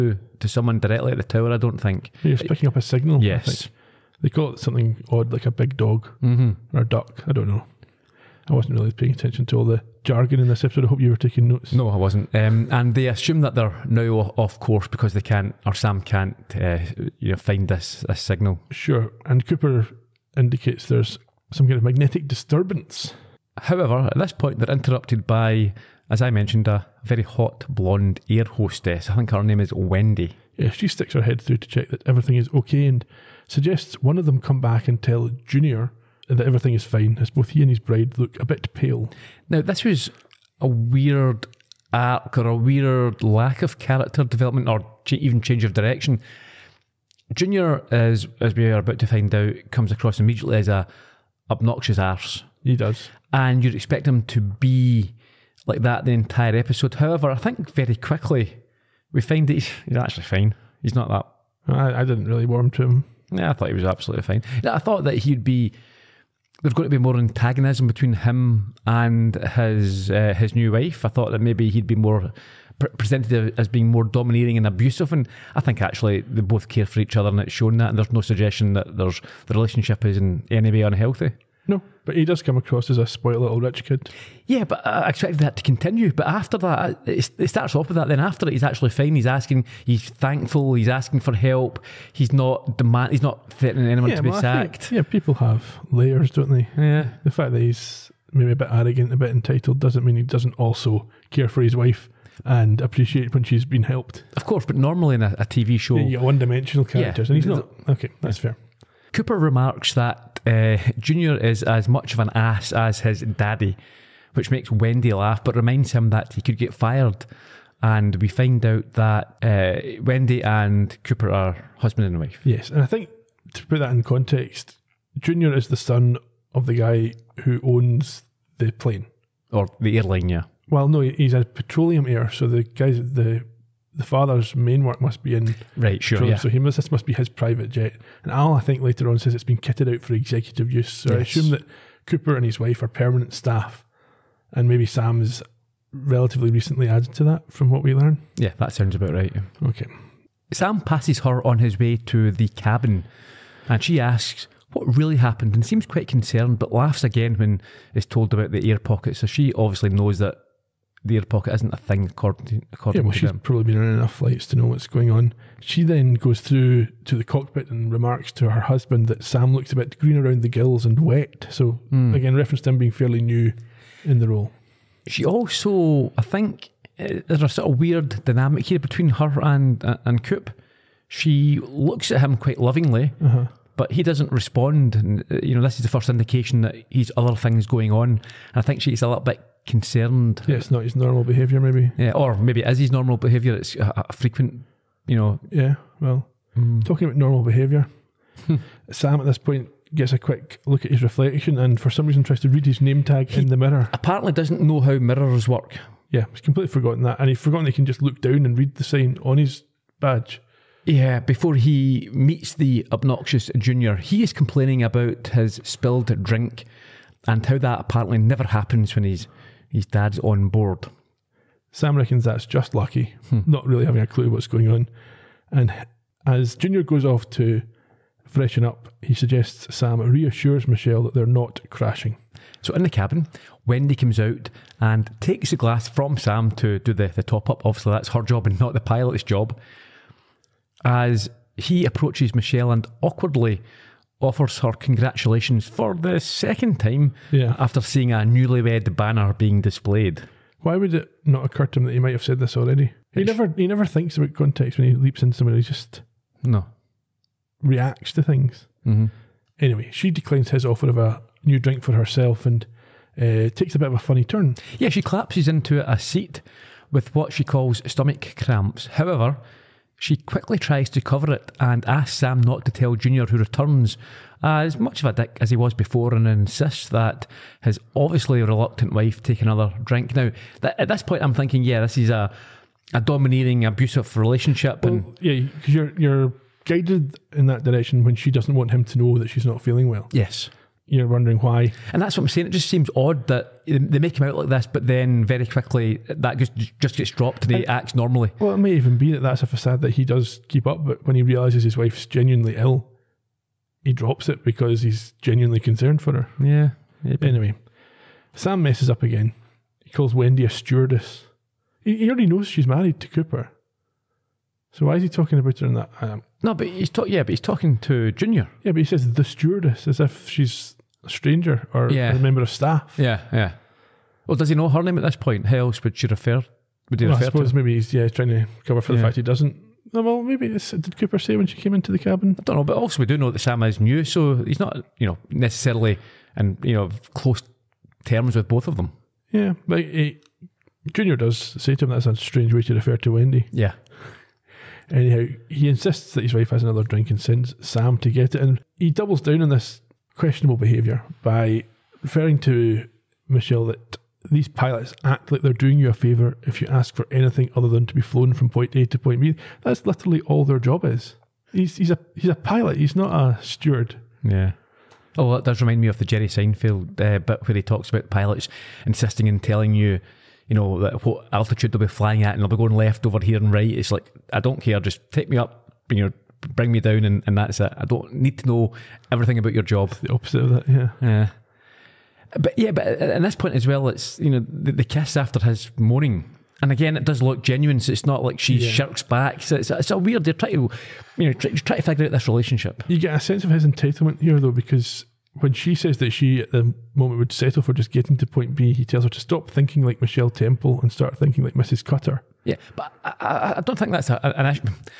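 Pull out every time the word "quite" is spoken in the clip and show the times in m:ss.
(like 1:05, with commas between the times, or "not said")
2:35, 3:02.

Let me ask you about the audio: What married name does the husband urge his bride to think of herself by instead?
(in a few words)
Mrs. Cutter.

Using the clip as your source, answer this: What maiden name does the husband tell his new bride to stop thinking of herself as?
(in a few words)
Michelle Temple.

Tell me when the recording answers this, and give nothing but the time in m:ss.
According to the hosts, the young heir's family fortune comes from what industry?
2:11.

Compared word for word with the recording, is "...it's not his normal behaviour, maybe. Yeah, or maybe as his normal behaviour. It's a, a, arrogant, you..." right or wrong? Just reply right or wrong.
wrong.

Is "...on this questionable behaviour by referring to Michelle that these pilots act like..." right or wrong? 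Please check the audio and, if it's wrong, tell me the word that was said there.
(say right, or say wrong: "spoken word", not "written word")
right.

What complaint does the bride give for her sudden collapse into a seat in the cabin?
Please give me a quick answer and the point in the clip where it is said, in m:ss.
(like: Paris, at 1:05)
Stomach cramps, at 4:27.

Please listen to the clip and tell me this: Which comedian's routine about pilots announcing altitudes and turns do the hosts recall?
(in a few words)
Jerry Seinfeld.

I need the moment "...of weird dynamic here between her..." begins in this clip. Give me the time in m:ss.
2:57.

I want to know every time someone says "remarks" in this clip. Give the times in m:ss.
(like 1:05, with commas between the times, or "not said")
1:49, 2:47.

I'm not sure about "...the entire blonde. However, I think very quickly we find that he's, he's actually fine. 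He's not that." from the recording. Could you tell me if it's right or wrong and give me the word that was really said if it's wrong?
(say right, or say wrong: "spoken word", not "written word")
wrong: "episode", not "blonde".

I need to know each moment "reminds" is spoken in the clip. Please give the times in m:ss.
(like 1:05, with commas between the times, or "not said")
1:55, 6:05.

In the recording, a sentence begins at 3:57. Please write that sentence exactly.
Obviously, that's her job and not the pilot's job.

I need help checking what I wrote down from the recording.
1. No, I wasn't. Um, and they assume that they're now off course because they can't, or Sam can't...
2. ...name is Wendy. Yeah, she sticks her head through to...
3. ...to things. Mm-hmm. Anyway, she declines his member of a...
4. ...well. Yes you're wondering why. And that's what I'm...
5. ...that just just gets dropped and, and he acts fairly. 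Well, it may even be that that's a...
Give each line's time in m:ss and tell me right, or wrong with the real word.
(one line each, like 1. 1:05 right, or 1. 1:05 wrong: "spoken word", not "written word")
1. 0:11 right
2. 0:29 right
3. 4:18 wrong: "offer", not "member"
4. 4:49 right
5. 4:56 wrong: "normally", not "fairly".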